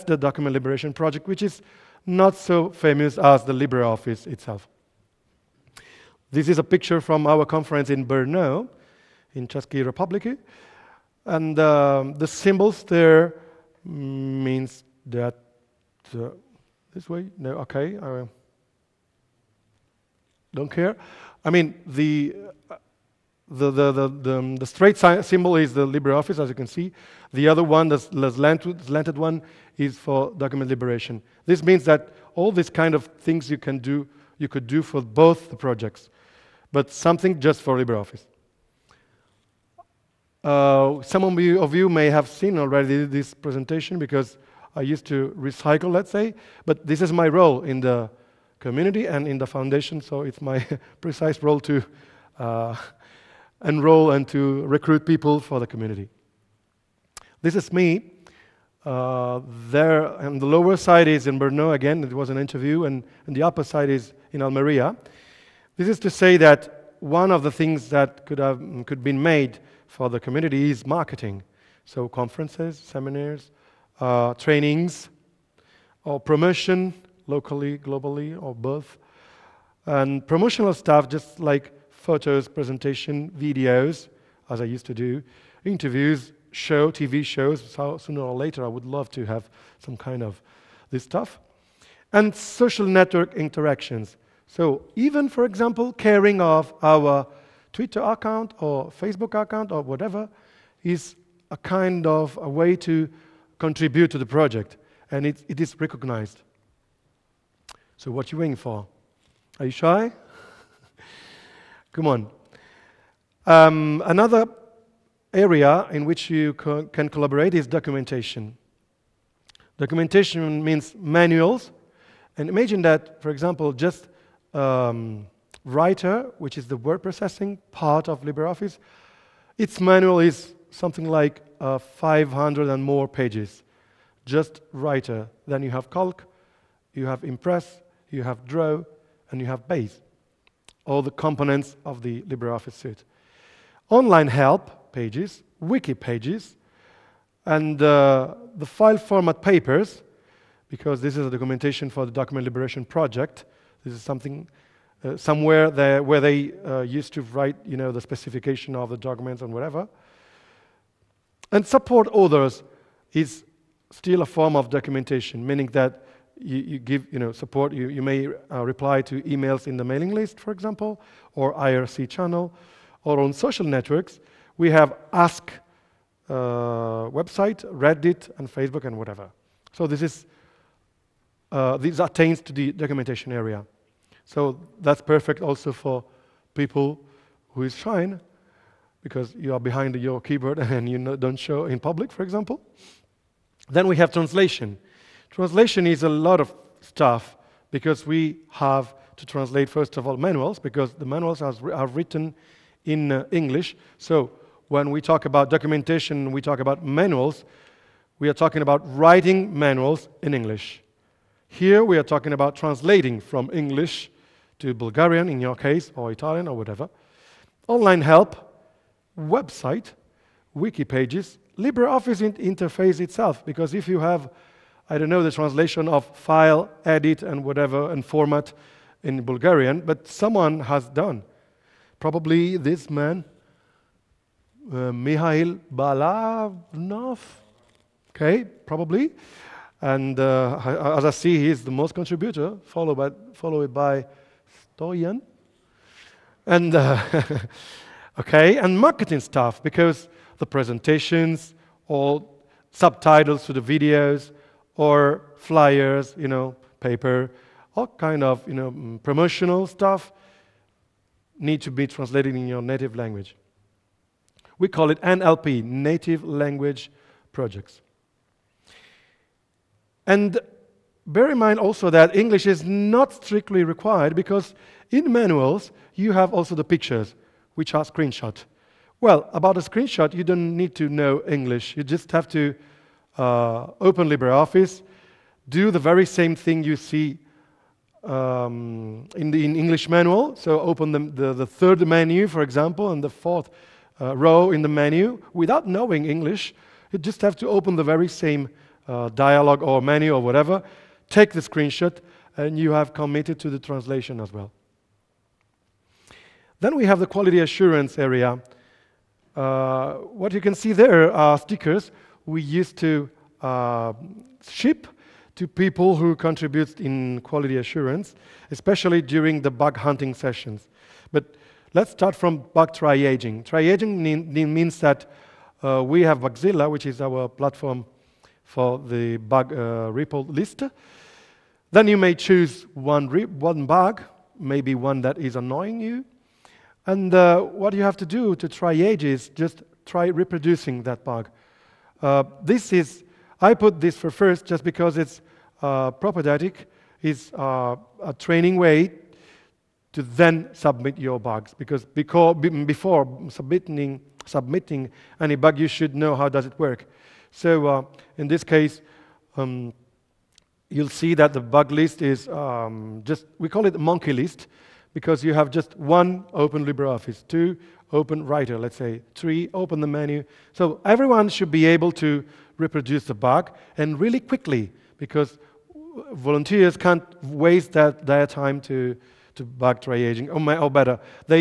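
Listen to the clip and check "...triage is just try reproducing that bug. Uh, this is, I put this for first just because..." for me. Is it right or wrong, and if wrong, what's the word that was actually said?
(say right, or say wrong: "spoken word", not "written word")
right.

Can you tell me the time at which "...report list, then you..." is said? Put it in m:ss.
5:29.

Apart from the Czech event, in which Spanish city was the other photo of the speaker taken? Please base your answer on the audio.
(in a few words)
Almeria.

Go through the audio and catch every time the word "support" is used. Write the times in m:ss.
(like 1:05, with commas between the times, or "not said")
2:41, 2:47.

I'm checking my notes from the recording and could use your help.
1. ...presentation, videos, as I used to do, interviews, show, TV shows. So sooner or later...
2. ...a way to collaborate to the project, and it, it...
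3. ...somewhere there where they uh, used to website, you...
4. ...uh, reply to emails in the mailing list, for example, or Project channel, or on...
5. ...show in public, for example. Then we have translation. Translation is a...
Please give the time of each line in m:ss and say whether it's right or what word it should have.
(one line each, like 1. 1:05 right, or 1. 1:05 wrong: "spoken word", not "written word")
1. 1:22 right
2. 1:42 wrong: "contribute", not "collaborate"
3. 2:35 wrong: "write", not "website"
4. 2:48 wrong: "IRC", not "Project"
5. 3:11 right.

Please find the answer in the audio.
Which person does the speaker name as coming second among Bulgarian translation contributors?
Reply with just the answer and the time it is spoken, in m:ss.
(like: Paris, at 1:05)
Dorian, at 4:04.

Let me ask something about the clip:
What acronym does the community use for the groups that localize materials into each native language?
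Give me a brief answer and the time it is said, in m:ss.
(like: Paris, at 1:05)
NLP, at 4:25.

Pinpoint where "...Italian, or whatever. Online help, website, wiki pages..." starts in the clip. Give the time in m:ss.
3:36.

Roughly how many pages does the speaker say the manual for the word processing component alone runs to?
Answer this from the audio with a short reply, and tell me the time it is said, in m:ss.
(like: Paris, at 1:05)
500, at 2:11.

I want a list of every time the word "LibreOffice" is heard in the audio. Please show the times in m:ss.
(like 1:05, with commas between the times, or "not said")
0:03, 0:25, 0:37, 2:08, 2:22, 3:41, 4:44, 6:06.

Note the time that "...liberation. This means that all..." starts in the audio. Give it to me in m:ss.
0:30.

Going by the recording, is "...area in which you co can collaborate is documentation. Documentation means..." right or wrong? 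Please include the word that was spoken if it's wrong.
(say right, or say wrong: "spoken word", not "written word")
right.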